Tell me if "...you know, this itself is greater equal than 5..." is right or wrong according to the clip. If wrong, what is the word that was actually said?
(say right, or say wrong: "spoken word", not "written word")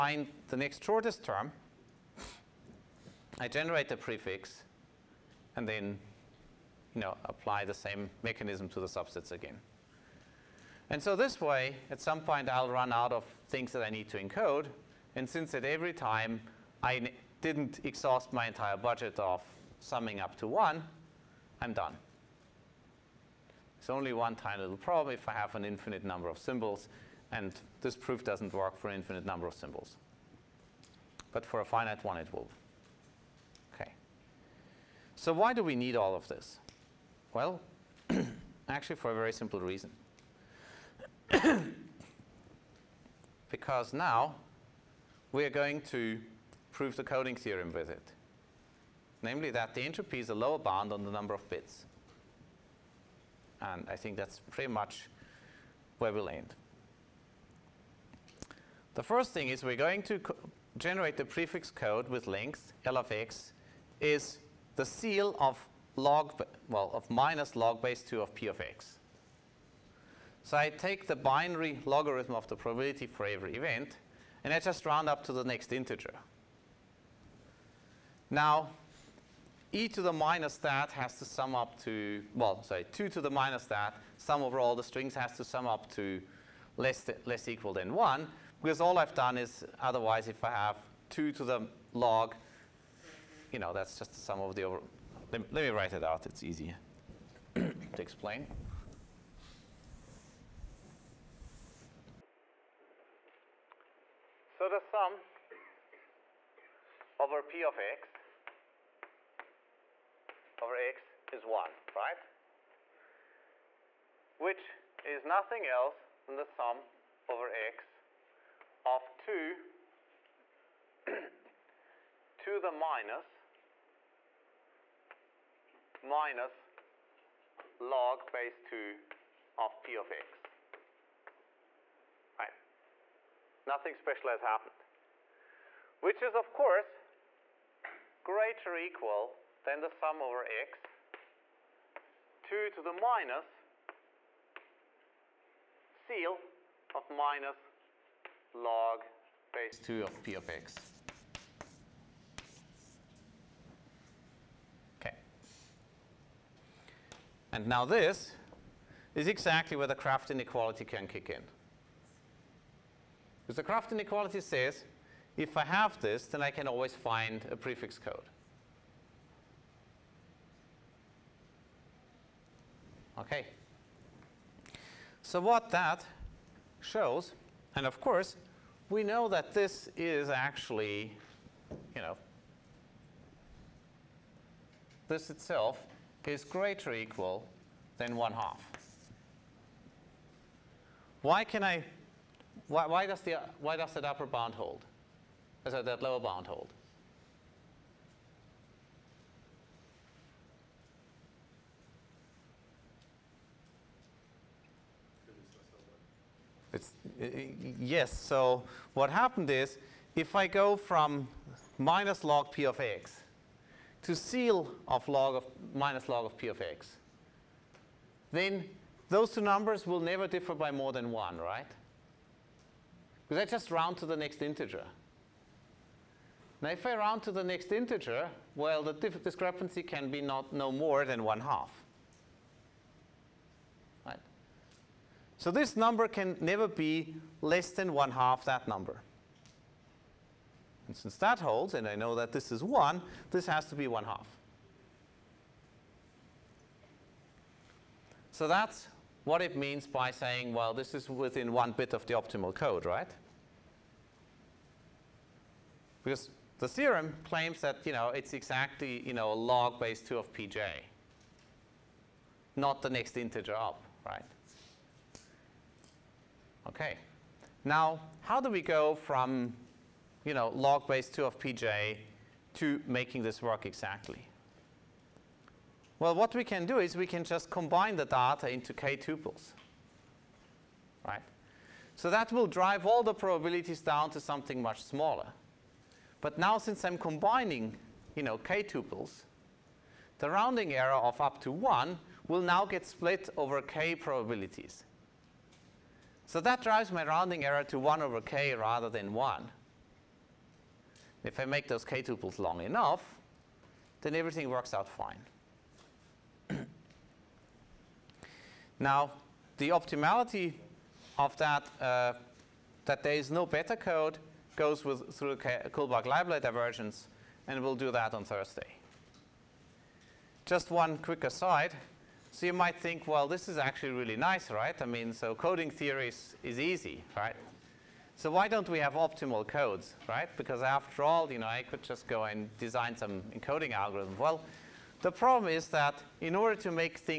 wrong: "1", not "5".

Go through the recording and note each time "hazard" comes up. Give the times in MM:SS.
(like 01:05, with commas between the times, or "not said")
not said.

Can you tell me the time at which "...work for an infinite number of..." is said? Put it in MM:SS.
00:28.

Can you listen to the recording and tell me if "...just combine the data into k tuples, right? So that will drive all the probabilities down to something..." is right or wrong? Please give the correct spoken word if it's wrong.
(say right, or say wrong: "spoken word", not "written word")
right.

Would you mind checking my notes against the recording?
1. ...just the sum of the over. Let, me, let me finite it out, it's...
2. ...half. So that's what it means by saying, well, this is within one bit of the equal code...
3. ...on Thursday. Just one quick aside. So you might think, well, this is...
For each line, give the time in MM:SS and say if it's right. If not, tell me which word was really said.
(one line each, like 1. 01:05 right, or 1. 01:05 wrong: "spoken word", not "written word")
1. 01:33 wrong: "write", not "finite"
2. 04:04 wrong: "optimal", not "equal"
3. 05:18 right.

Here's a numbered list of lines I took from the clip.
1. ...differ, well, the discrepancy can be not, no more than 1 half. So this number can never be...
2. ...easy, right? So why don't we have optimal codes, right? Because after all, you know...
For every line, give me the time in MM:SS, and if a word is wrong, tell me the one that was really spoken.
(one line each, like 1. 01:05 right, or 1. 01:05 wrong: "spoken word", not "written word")
1. 03:47 wrong: "integer", not "differ"
2. 05:26 right.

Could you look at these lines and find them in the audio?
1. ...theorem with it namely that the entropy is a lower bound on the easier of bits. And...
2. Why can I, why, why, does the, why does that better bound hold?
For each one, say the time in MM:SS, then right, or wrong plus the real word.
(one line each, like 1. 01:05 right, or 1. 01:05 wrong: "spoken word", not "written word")
1. 00:47 wrong: "number", not "easier"
2. 03:11 wrong: "upper", not "better".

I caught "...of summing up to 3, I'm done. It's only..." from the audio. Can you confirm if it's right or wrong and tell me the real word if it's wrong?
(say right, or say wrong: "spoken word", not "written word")
wrong: "1", not "3".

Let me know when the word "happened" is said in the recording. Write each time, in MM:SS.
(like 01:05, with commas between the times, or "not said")
02:14, 03:29.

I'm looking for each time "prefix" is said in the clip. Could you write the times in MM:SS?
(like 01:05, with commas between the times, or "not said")
00:03, 01:01, 02:47.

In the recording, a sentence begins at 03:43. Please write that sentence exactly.
Because I just round to the next integer.